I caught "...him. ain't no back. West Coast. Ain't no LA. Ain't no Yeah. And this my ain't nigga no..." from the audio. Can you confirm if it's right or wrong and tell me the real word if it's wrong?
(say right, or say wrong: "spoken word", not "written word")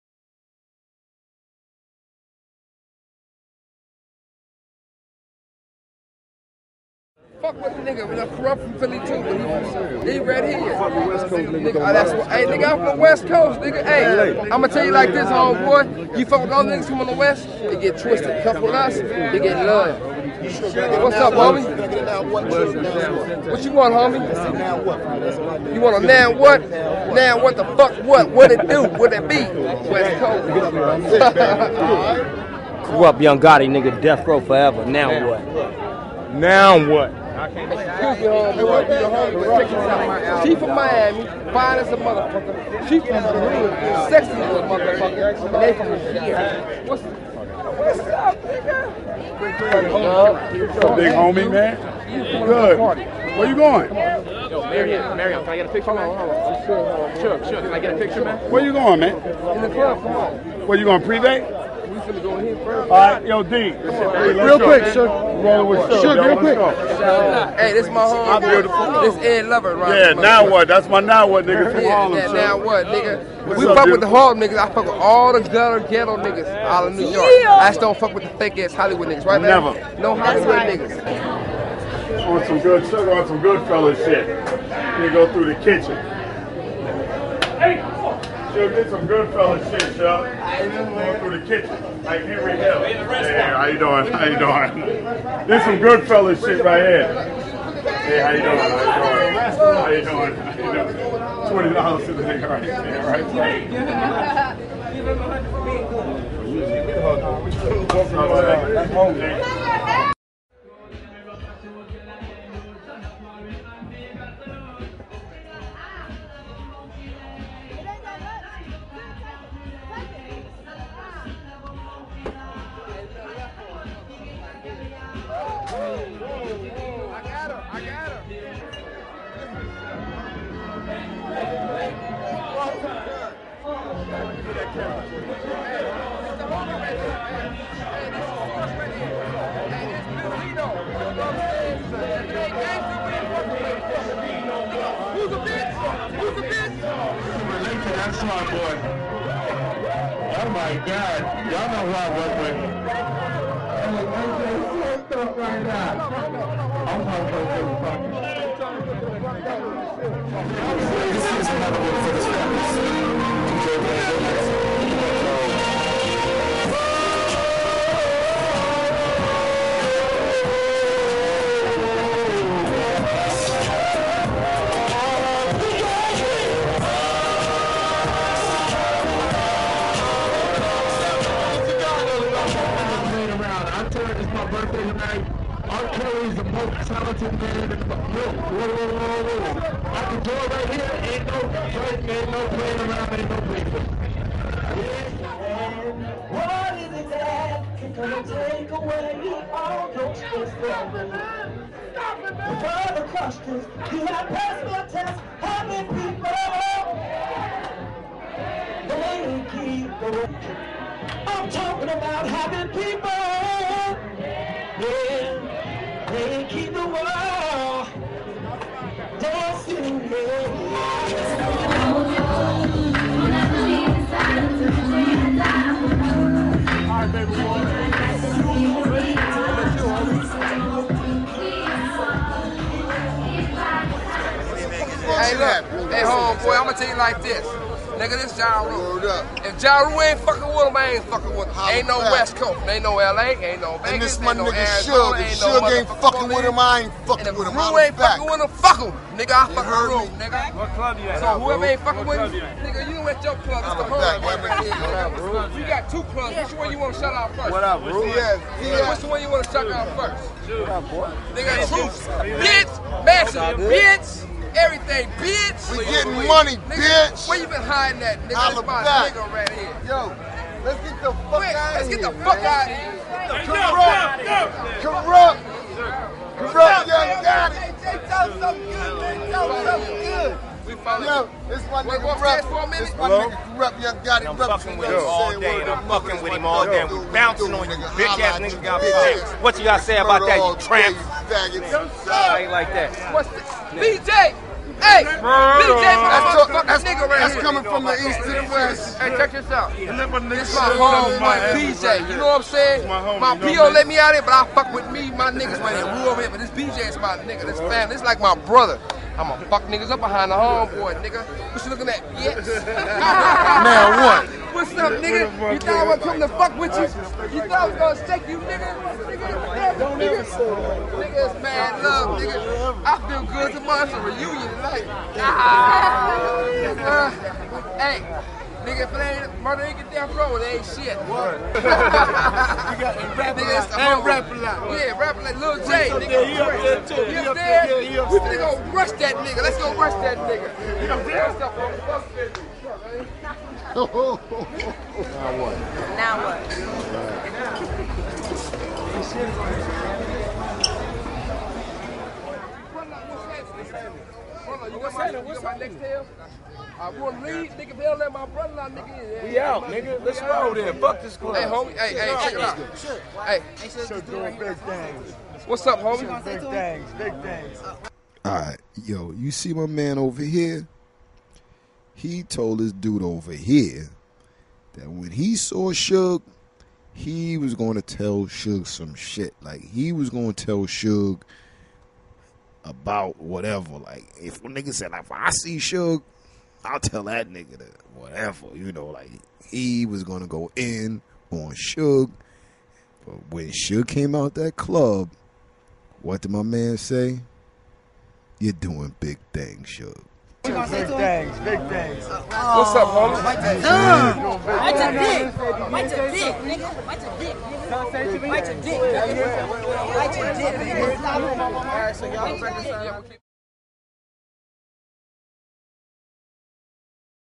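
wrong: "Vegas", not "Yeah".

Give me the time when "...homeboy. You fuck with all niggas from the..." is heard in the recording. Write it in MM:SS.
00:15.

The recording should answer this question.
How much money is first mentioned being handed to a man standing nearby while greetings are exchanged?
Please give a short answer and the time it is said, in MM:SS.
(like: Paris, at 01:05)
$20, at 01:41.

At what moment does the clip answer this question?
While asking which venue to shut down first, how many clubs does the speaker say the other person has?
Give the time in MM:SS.
04:15.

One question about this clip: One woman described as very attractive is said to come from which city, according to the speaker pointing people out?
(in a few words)
Miami.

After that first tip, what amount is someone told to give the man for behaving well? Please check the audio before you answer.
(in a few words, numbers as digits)
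100.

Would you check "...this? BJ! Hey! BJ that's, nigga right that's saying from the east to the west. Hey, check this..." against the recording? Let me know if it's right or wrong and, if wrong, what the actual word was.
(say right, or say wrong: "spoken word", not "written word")
wrong: "coming", not "saying".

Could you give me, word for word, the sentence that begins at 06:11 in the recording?
he told this dude over here that when he saw Suge, he was going to tell Suge some shit.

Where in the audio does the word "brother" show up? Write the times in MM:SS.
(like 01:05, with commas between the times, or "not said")
05:08, 05:58.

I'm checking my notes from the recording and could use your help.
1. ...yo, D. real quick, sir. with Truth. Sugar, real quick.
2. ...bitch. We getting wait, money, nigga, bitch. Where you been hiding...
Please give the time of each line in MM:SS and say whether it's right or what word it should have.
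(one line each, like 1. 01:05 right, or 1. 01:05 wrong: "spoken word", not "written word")
1. 01:03 wrong: "Sugar", not "Truth"
2. 04:25 right.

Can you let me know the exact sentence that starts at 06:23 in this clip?
Like if a nigga said like, if I see Suge, I'll tell that nigga that whatever.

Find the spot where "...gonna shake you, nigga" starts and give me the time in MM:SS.
05:17.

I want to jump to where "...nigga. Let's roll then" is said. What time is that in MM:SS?
05:59.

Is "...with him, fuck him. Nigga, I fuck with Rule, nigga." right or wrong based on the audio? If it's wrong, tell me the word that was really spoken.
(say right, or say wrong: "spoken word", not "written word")
right.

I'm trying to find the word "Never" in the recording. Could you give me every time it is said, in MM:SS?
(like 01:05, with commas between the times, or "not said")
01:19.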